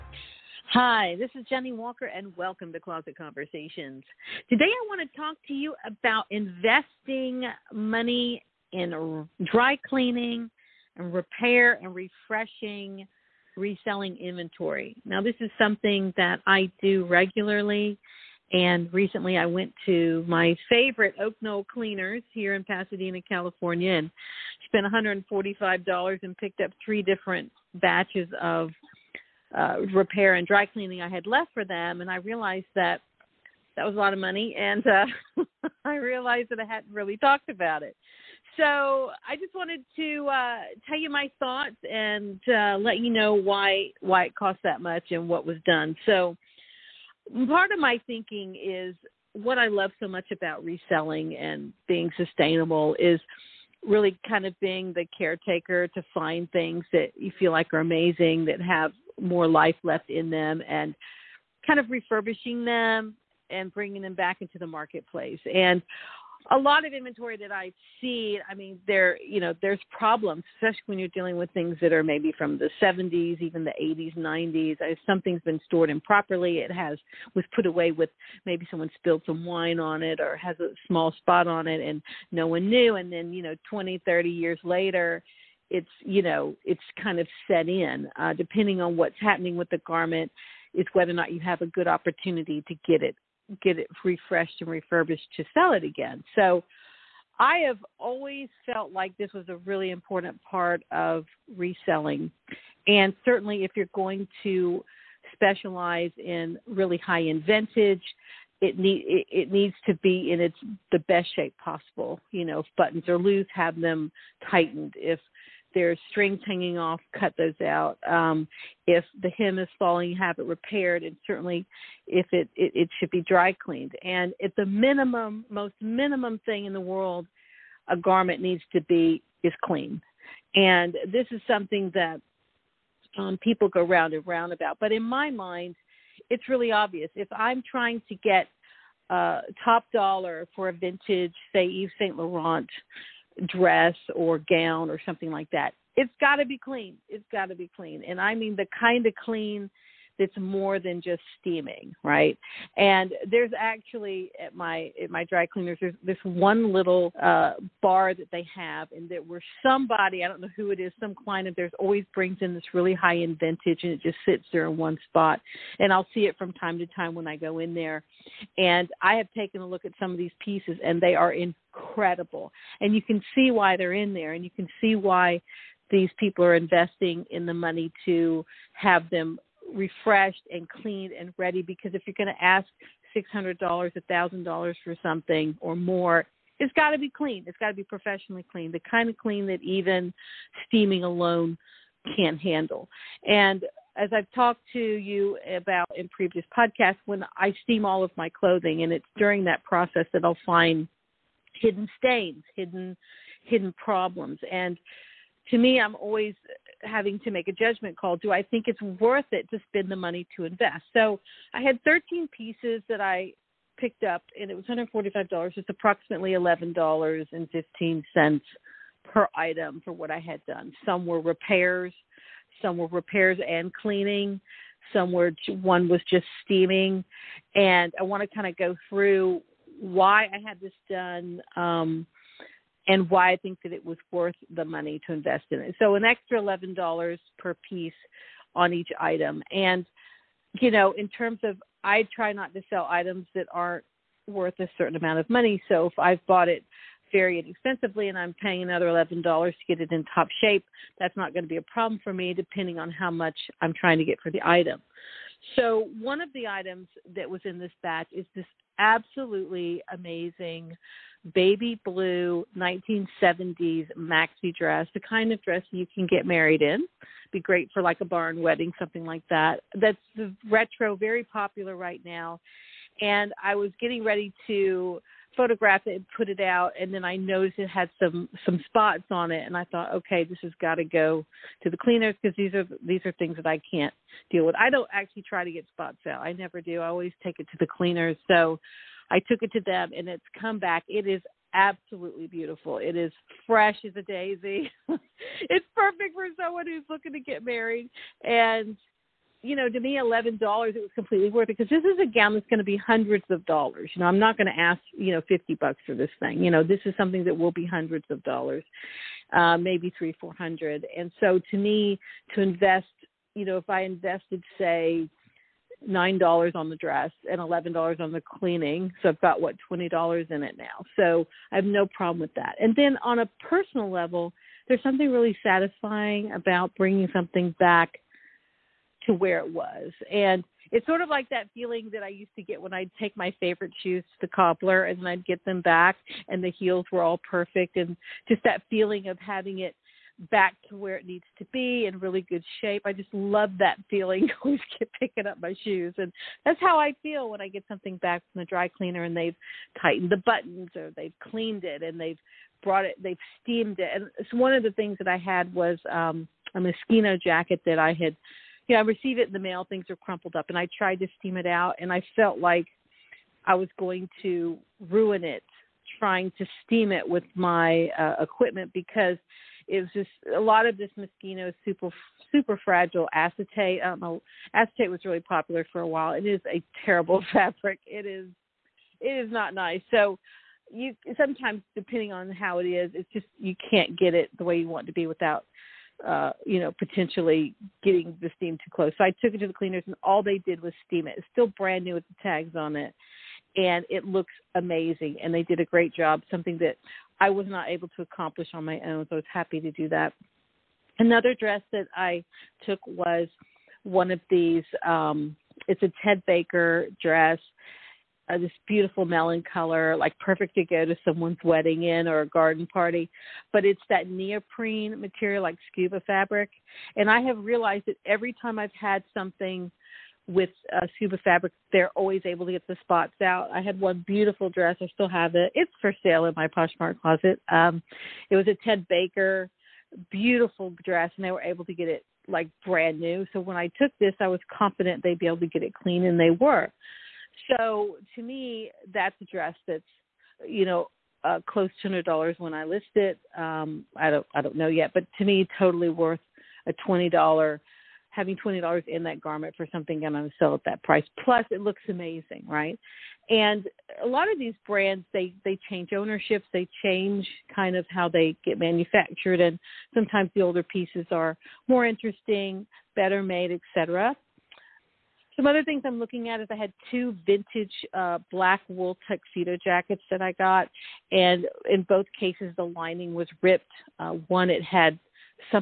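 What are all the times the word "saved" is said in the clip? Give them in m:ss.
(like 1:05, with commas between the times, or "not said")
not said.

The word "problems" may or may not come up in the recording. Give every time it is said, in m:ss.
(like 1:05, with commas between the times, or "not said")
1:09, 3:23, 4:11, 5:21.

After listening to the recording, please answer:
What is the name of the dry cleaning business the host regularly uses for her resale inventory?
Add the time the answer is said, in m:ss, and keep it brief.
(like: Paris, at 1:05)
Oak Knoll Cleaners, at 0:21.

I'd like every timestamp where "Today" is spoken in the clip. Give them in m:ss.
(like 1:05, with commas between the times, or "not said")
0:04.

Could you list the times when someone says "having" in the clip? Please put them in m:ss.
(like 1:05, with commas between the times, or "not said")
3:26, 5:39, 7:28.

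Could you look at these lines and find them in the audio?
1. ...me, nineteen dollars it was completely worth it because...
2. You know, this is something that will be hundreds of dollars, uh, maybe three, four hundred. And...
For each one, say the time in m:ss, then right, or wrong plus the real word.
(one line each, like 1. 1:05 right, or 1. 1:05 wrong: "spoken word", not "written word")
1. 4:59 wrong: "eleven", not "nineteen"
2. 5:06 right.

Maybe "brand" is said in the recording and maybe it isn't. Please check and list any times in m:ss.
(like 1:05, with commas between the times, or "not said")
6:31, 7:12, 7:34.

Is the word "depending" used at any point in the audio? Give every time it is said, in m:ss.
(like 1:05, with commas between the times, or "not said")
1:28, 4:12, 6:21.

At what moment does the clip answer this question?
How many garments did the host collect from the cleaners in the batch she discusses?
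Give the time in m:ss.
3:31.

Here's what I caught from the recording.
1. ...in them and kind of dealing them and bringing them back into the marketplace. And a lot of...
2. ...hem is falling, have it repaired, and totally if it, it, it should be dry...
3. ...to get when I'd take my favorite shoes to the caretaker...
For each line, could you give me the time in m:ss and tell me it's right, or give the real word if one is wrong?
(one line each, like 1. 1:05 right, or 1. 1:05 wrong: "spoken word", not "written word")
1. 1:00 wrong: "refurbishing", not "dealing"
2. 1:59 wrong: "certainly", not "totally"
3. 5:32 wrong: "cobbler", not "caretaker".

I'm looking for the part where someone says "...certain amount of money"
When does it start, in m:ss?
4:04.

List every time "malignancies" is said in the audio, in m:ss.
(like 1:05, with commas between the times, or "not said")
not said.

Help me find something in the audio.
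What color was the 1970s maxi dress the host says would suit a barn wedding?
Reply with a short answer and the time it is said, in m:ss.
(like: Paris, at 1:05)
Baby blue, at 4:21.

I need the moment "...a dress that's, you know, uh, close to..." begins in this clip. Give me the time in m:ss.
7:19.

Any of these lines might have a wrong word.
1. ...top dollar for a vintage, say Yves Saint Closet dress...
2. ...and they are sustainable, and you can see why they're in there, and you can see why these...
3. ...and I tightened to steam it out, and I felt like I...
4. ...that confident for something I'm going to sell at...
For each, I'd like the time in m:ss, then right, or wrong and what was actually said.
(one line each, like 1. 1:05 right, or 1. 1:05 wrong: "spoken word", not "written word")
1. 2:19 wrong: "Laurent", not "Closet"
2. 2:50 wrong: "incredible", not "sustainable"
3. 6:00 wrong: "tried", not "tightened"
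4. 7:29 wrong: "garment", not "confident".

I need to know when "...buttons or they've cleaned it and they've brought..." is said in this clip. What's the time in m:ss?
5:50.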